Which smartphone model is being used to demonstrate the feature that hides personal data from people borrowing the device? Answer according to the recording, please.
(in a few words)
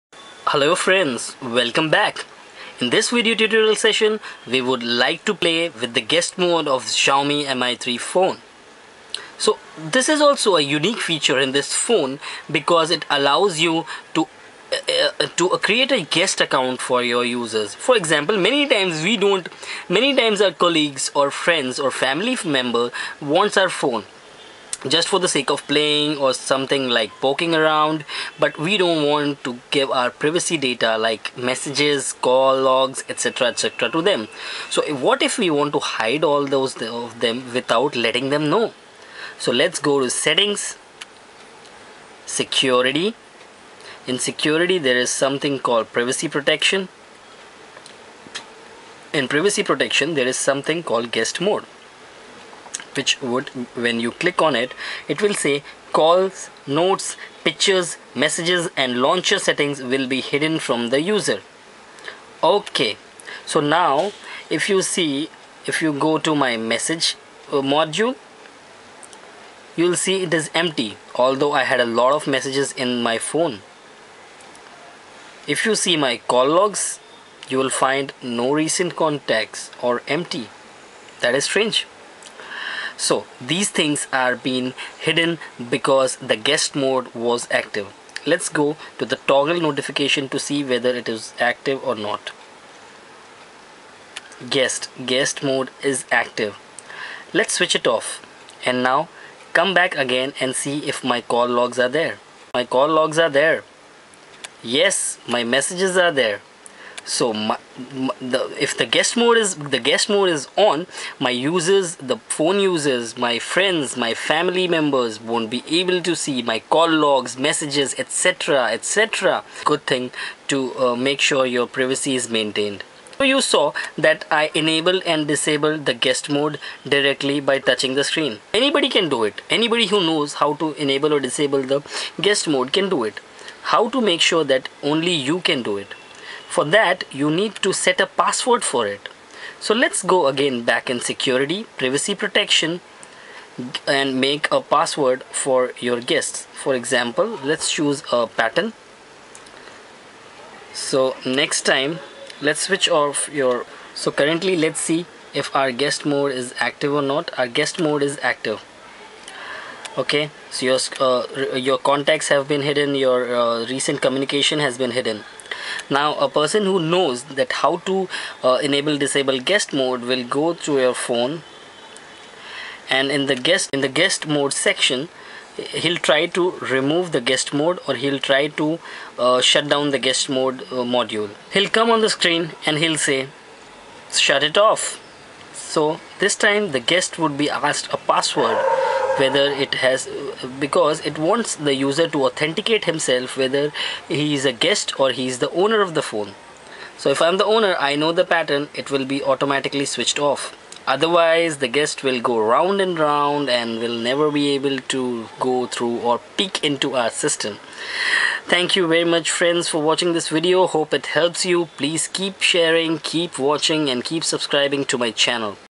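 Xiaomi Mi3.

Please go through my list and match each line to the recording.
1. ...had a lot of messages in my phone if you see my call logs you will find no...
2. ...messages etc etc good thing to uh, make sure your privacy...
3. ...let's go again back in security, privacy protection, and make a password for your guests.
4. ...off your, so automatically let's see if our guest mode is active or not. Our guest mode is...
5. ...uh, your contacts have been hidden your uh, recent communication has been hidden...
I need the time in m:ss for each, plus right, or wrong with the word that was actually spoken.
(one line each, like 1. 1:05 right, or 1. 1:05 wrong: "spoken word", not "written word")
1. 1:11 right
2. 1:57 right
3. 2:19 right
4. 2:32 wrong: "currently", not "automatically"
5. 2:41 right.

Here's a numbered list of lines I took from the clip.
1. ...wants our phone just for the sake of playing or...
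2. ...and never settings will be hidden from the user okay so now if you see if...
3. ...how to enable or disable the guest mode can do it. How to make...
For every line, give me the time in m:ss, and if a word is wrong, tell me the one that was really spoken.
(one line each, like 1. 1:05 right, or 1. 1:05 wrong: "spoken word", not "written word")
1. 0:23 right
2. 0:58 wrong: "launcher", not "never"
3. 2:10 right.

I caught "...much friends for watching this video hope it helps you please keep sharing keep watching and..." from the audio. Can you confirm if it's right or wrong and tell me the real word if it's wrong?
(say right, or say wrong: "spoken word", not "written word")
right.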